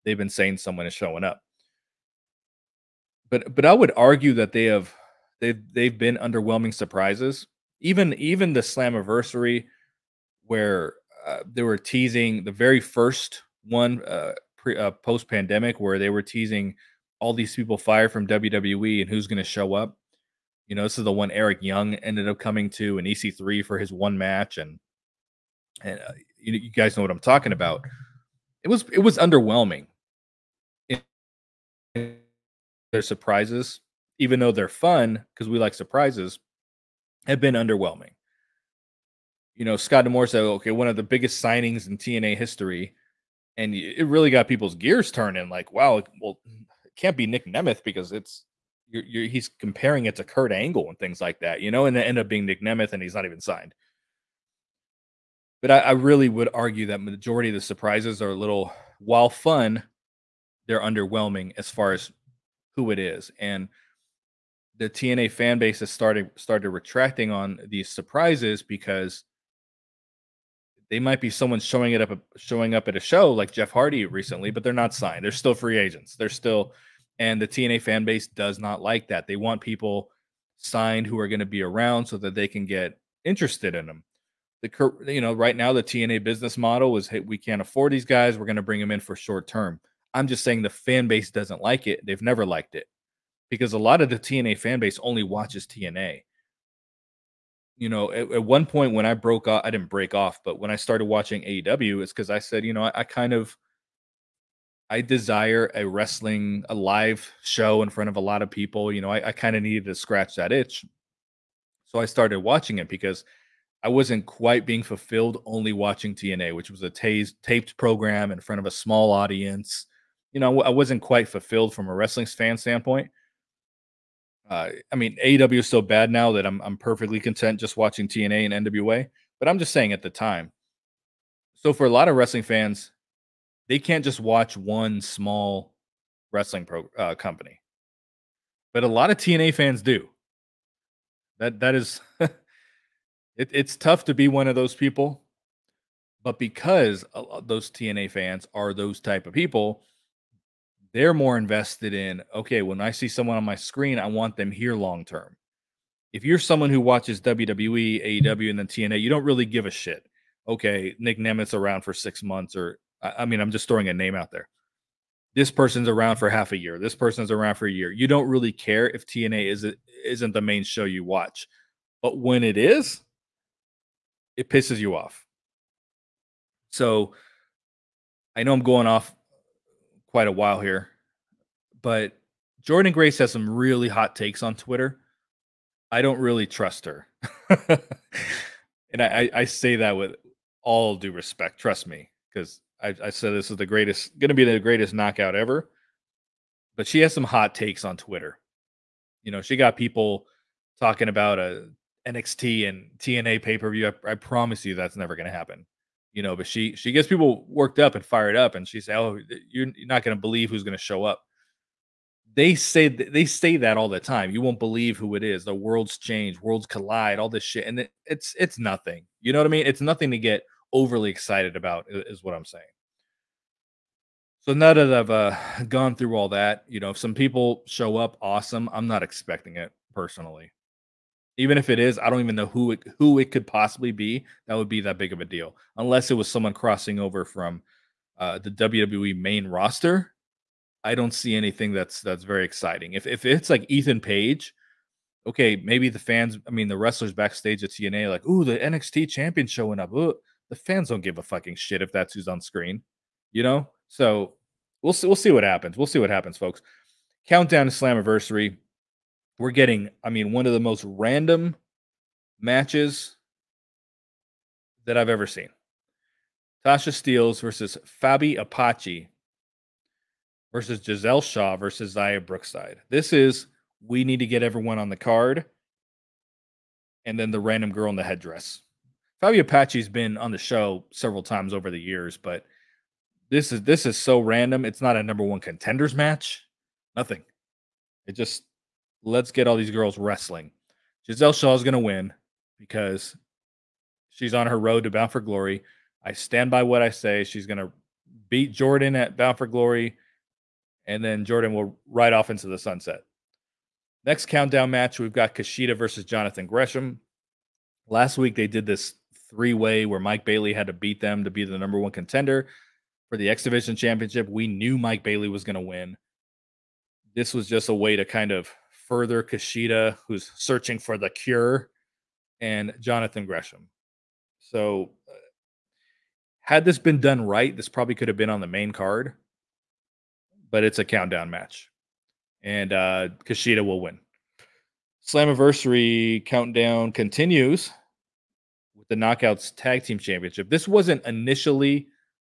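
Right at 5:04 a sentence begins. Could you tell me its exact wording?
Next countdown match, we've got Kushida versus Jonathan Gresham.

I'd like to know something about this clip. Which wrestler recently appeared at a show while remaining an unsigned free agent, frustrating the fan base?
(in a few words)
Jeff Hardy.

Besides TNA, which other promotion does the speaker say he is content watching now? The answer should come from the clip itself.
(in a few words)
NWA.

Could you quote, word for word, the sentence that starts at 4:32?
This is we need to get everyone on the card.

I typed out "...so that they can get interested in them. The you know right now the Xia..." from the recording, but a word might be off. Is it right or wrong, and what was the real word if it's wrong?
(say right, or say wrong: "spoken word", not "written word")
wrong: "TNA", not "Xia".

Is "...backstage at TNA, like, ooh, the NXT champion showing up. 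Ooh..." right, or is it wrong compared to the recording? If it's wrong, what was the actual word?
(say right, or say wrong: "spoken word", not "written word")
right.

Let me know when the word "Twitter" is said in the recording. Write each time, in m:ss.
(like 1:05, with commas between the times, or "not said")
3:04, 3:17.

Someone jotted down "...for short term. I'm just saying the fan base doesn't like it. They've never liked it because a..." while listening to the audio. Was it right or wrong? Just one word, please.
right.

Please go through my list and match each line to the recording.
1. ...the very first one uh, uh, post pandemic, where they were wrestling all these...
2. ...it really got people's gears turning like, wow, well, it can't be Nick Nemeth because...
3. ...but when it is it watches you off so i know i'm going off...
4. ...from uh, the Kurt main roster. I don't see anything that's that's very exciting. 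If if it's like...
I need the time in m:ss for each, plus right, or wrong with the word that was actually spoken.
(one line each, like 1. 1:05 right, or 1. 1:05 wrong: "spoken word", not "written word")
1. 0:12 wrong: "teasing", not "wrestling"
2. 0:43 right
3. 2:52 wrong: "pisses", not "watches"
4. 3:57 wrong: "WWE", not "Kurt".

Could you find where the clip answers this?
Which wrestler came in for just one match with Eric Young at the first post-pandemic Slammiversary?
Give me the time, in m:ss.
0:23.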